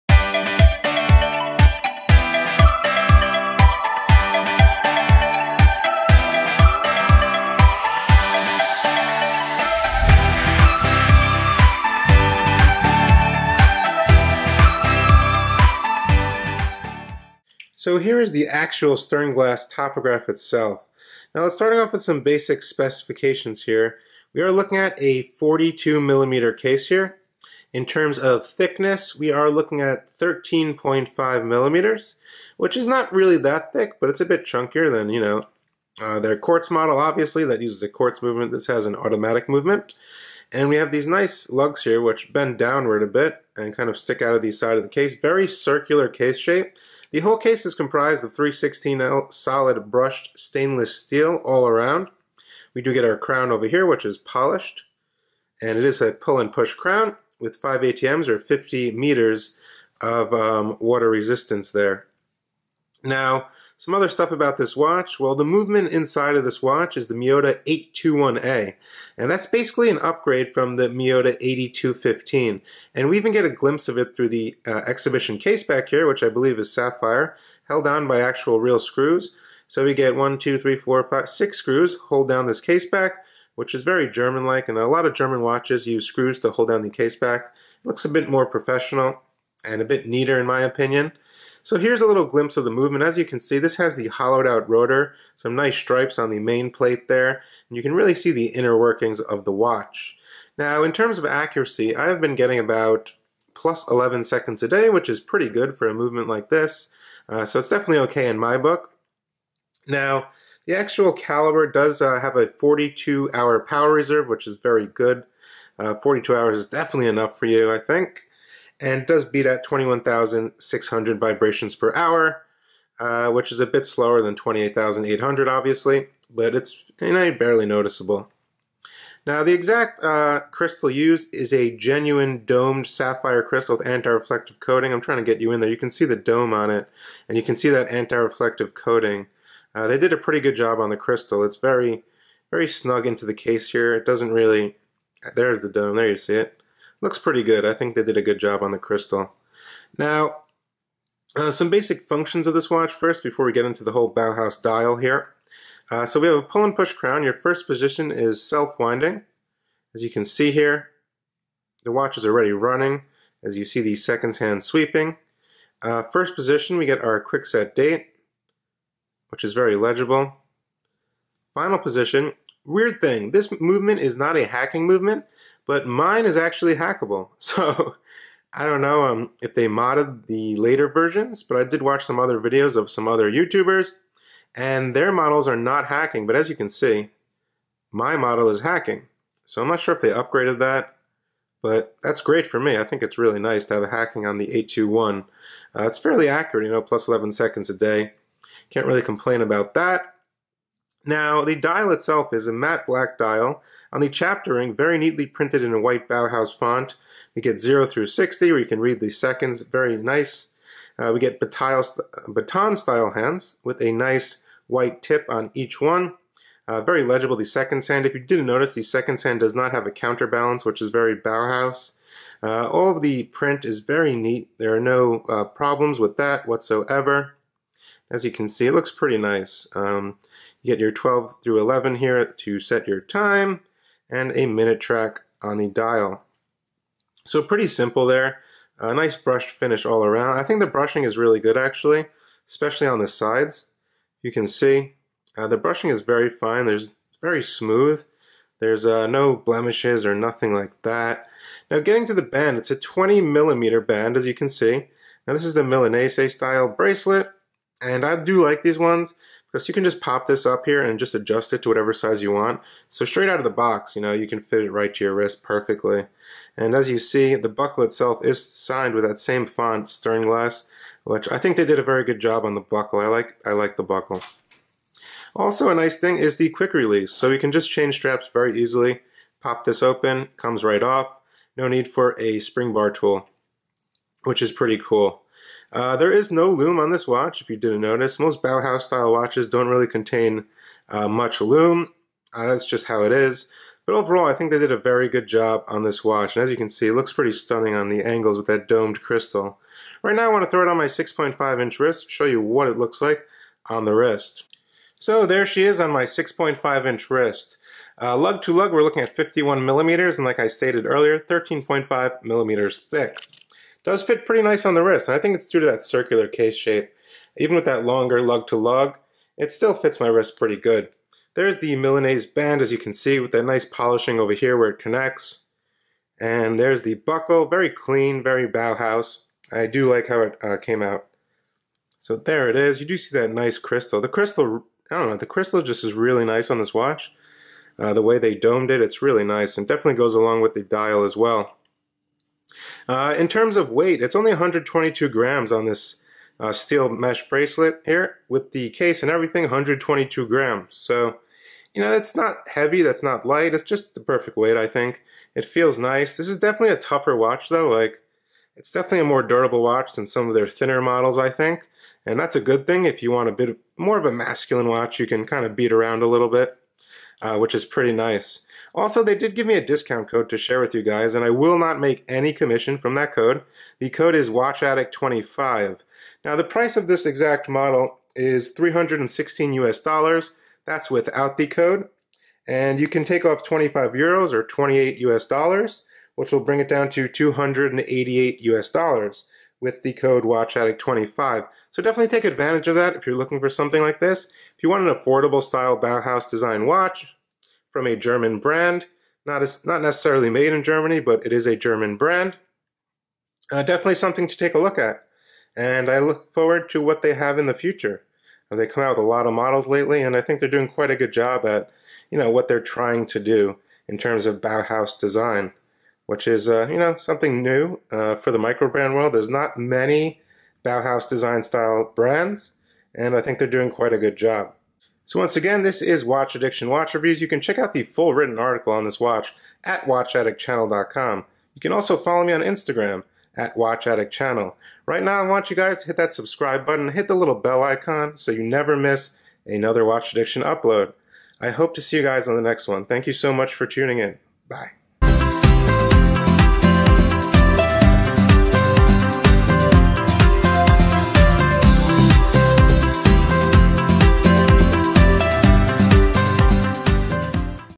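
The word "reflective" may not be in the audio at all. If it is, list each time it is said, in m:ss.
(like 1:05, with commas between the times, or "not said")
2:13, 2:17.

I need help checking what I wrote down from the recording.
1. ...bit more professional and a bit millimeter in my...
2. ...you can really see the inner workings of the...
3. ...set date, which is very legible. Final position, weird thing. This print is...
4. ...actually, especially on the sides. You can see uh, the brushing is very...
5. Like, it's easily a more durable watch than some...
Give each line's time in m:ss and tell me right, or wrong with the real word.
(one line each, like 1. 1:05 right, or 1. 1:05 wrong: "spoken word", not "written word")
1. 1:28 wrong: "neater", not "millimeter"
2. 1:37 right
3. 2:47 wrong: "movement", not "print"
4. 4:01 right
5. 5:57 wrong: "definitely", not "easily".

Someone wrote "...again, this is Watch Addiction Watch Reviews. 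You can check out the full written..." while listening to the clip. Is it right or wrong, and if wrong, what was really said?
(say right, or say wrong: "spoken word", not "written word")
right.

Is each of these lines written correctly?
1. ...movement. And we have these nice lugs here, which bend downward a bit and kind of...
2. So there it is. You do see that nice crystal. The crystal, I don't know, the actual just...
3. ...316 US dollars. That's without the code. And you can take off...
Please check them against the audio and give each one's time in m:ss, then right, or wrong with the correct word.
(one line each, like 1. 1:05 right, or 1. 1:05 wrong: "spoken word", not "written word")
1. 0:39 right
2. 5:31 wrong: "crystal", not "actual"
3. 6:18 right.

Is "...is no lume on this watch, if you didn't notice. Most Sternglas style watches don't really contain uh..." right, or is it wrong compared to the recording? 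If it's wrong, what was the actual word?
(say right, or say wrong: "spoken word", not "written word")
wrong: "Bauhaus", not "Sternglas".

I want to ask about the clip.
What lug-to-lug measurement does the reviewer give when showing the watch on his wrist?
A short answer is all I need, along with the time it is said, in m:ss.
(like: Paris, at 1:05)
51 mm, at 5:09.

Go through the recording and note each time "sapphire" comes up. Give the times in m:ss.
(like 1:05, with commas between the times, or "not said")
1:16, 2:12.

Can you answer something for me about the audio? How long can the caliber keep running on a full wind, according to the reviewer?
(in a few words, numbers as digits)
42 hours.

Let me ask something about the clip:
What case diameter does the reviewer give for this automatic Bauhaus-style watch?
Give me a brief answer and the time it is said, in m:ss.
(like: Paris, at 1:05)
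42 mm, at 0:25.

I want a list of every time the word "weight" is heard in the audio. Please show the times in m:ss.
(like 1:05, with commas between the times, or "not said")
5:43, 5:54.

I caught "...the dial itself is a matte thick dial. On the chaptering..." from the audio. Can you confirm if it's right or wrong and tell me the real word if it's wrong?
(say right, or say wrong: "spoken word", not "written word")
wrong: "black", not "thick".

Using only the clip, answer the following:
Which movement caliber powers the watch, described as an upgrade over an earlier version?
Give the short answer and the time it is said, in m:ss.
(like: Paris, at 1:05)
Miyota 821A, at 1:07.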